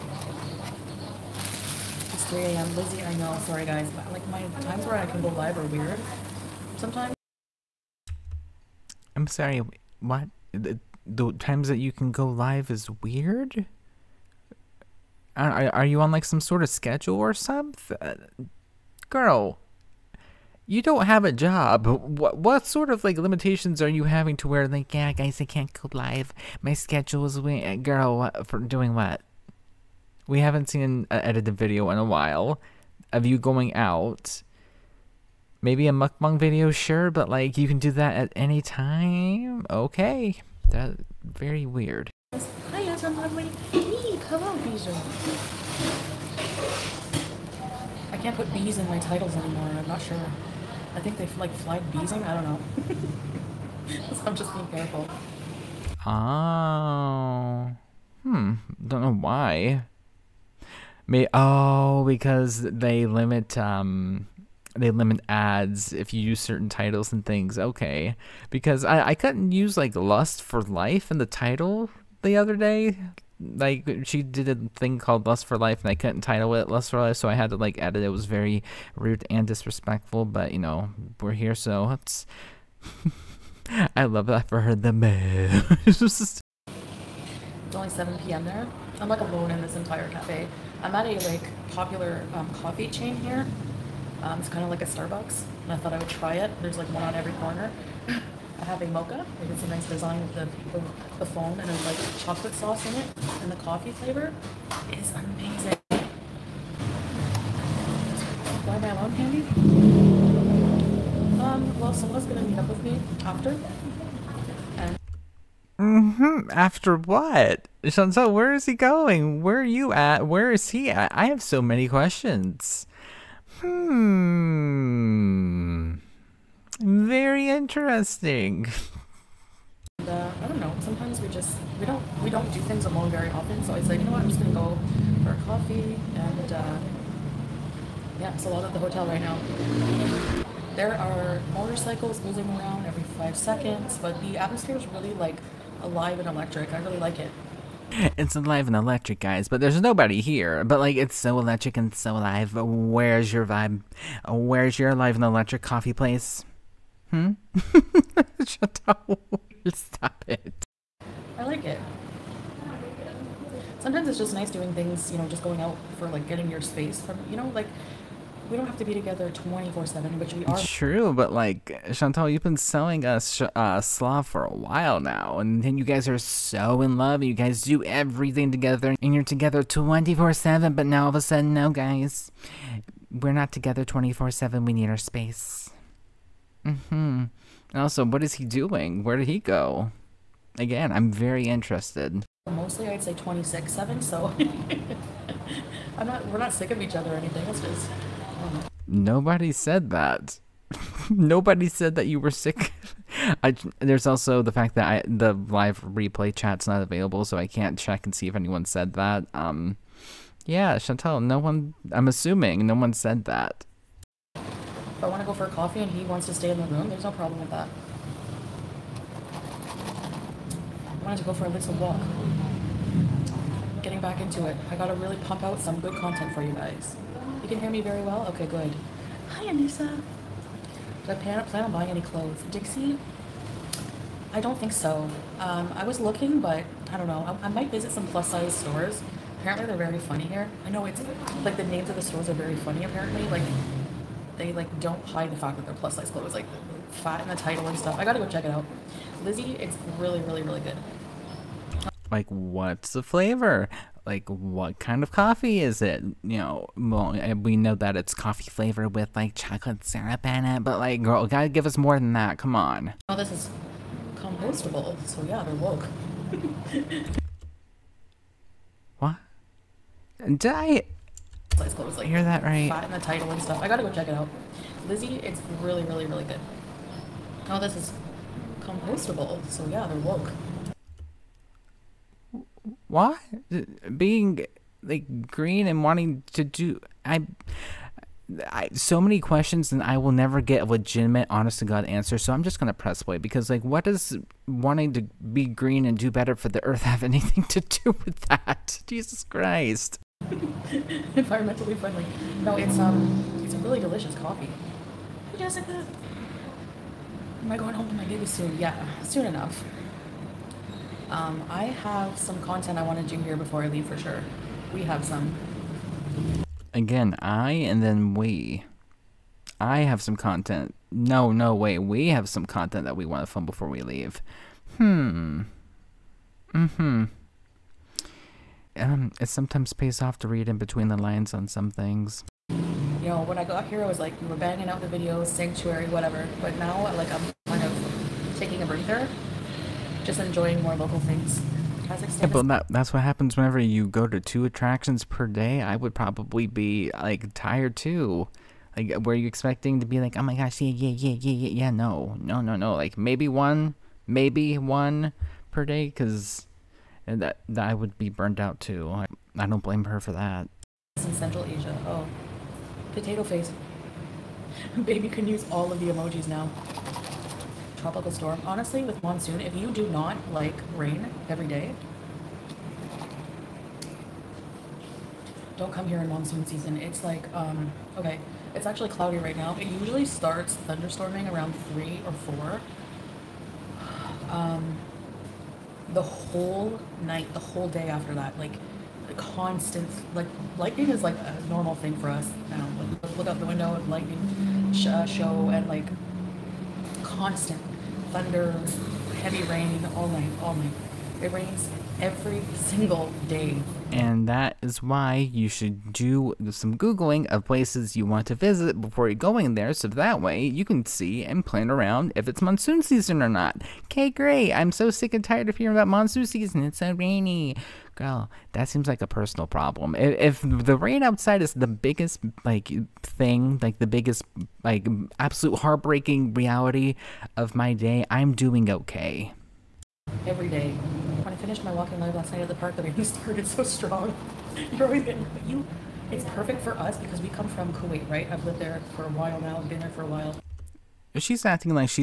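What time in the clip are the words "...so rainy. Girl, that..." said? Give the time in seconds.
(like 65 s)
416 s.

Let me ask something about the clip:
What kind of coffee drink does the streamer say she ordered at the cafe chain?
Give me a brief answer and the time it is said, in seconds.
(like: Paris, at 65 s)
Mocha, at 98 s.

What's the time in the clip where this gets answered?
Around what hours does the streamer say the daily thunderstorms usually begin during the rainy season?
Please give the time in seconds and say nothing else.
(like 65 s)
381 s.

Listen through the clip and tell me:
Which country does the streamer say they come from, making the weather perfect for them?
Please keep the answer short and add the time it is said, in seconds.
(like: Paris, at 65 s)
Kuwait, at 437 s.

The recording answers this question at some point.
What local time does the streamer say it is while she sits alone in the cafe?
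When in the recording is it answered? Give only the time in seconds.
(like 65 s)
87 s.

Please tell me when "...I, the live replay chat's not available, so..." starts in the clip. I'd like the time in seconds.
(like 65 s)
204 s.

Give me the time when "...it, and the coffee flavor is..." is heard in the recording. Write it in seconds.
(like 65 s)
103 s.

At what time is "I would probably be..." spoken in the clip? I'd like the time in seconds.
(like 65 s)
345 s.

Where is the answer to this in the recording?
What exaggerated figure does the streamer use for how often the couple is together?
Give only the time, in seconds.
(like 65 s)
193 s.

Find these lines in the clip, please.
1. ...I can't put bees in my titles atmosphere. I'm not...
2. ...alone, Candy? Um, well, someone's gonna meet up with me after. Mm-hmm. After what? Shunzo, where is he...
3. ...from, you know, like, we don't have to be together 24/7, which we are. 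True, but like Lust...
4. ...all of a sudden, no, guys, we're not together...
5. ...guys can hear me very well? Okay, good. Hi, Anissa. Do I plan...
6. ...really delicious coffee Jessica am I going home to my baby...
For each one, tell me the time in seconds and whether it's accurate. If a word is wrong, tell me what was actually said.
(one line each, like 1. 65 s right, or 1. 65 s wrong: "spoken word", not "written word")
1. 48 s wrong: "anymore", not "atmosphere"
2. 108 s right
3. 166 s wrong: "Chantal", not "Lust"
4. 181 s right
5. 226 s right
6. 303 s right.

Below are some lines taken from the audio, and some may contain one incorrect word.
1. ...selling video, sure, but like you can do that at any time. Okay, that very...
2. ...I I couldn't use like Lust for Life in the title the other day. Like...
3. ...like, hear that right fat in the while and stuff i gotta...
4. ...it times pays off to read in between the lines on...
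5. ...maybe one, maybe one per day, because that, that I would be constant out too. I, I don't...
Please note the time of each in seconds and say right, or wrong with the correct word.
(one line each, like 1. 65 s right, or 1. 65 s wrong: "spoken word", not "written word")
1. 35 s wrong: "mukbang", not "selling"
2. 68 s right
3. 271 s wrong: "title", not "while"
4. 329 s wrong: "sometimes", not "times"
5. 352 s wrong: "burnt", not "constant".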